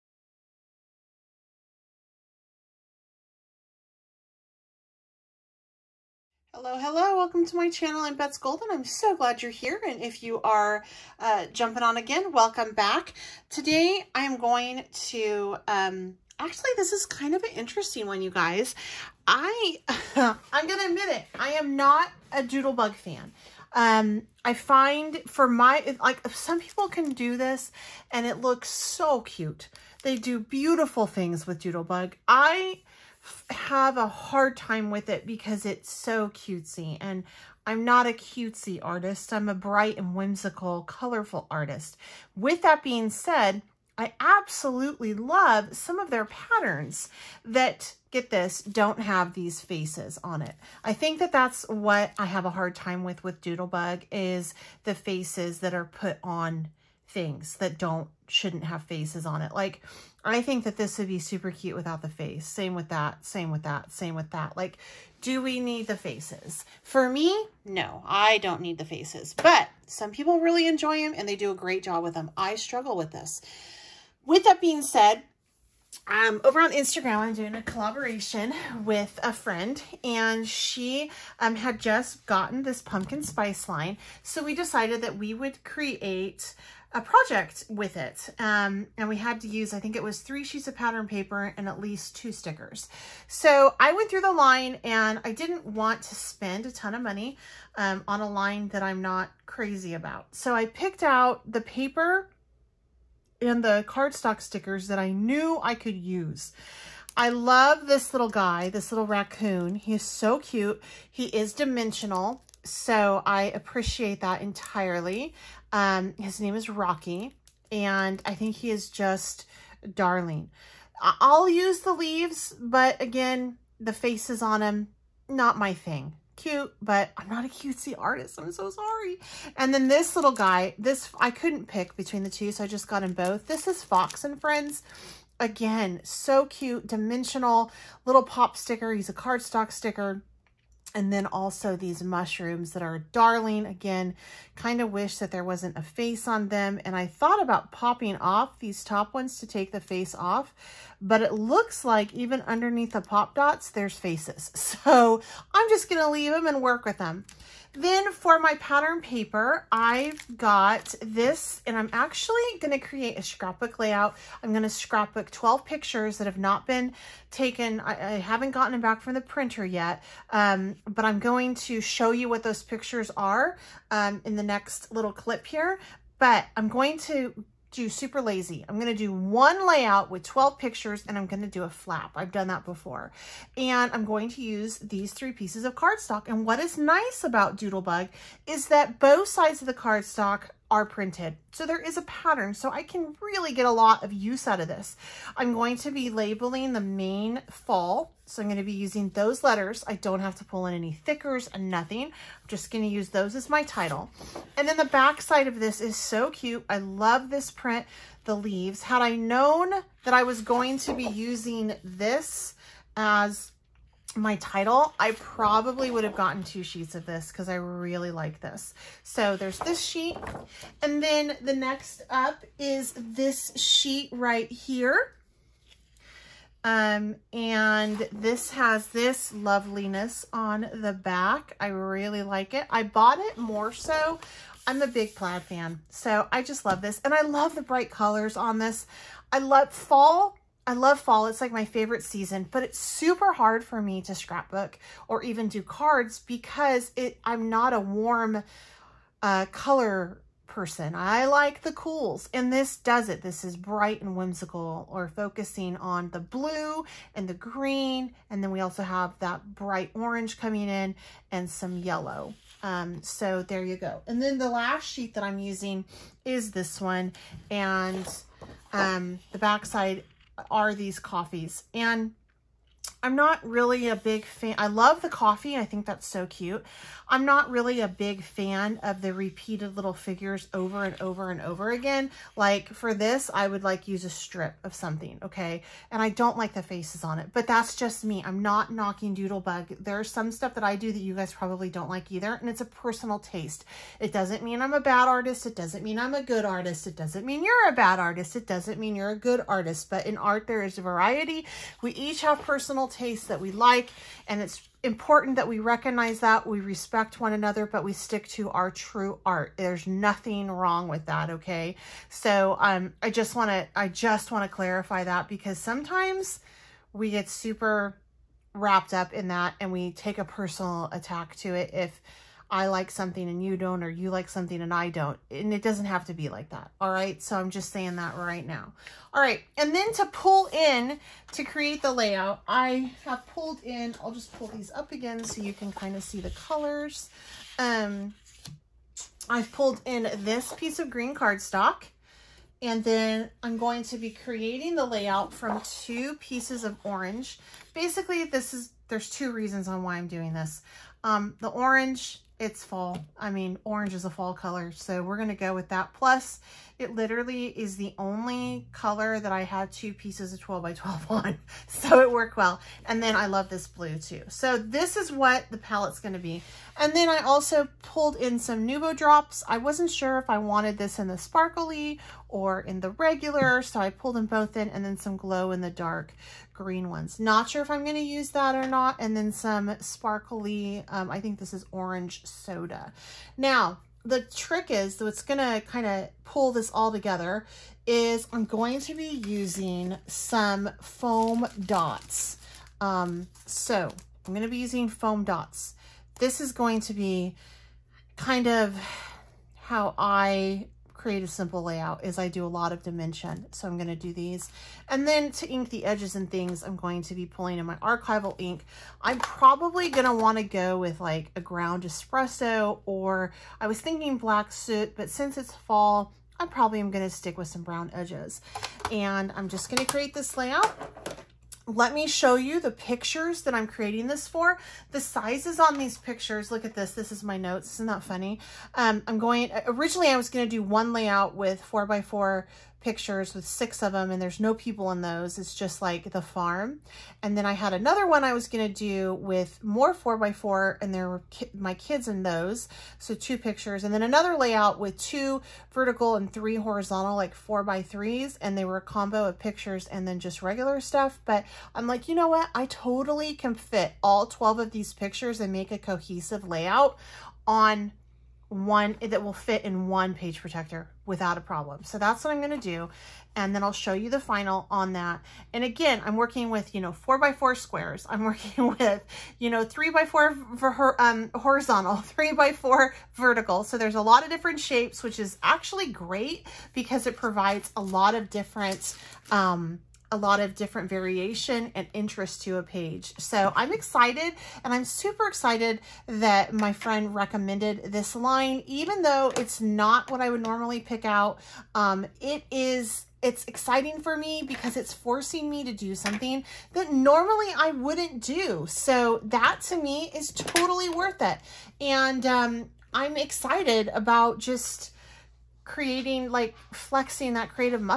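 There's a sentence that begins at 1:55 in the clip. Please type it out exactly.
Um, his name is Rocky, and I think he is just darling.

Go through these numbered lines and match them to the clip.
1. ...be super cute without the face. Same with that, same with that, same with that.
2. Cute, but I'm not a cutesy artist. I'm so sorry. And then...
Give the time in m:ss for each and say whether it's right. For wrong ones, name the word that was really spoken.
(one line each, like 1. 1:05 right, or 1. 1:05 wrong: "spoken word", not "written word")
1. 1:01 right
2. 2:06 right.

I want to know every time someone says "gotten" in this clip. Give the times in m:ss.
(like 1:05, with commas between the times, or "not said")
1:22, 2:48, 3:36.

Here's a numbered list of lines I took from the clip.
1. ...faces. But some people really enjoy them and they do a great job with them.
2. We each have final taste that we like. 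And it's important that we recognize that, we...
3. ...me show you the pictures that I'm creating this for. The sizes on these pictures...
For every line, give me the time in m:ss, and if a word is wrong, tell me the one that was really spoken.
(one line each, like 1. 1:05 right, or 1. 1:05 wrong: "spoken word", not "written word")
1. 1:08 right
2. 5:01 wrong: "personal", not "final"
3. 7:01 right.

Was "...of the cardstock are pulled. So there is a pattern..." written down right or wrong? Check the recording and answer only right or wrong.
wrong.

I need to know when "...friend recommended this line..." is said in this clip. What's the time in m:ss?
8:06.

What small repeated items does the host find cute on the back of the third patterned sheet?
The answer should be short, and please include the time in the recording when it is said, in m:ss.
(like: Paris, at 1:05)
coffees, at 4:30.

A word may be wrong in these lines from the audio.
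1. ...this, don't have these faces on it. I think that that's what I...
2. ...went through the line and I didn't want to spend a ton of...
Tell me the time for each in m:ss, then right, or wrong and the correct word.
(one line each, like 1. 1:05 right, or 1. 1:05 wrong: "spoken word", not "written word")
1. 0:48 right
2. 1:33 right.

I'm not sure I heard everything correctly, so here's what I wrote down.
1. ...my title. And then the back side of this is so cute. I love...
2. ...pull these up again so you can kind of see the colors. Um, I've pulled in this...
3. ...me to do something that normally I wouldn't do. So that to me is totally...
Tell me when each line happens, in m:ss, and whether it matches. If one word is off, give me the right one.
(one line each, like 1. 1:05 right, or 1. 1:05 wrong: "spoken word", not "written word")
1. 3:23 right
2. 5:34 right
3. 8:15 right.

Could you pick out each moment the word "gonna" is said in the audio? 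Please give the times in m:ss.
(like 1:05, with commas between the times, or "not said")
2:35, 6:25, 6:34, 7:42.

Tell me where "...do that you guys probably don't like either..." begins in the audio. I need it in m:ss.
4:50.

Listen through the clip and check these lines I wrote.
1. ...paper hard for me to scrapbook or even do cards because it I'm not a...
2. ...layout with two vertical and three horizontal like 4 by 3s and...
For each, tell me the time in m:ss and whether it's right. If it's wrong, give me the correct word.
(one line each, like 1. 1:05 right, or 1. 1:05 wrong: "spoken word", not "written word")
1. 4:02 wrong: "super", not "paper"
2. 7:24 right.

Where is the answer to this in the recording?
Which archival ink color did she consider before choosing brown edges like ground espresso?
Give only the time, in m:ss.
6:54.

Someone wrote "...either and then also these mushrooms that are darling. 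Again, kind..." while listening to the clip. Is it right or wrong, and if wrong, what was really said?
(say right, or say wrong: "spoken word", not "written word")
wrong: "sticker", not "either".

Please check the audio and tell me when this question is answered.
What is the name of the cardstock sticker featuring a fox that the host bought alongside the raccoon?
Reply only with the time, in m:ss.
2:13.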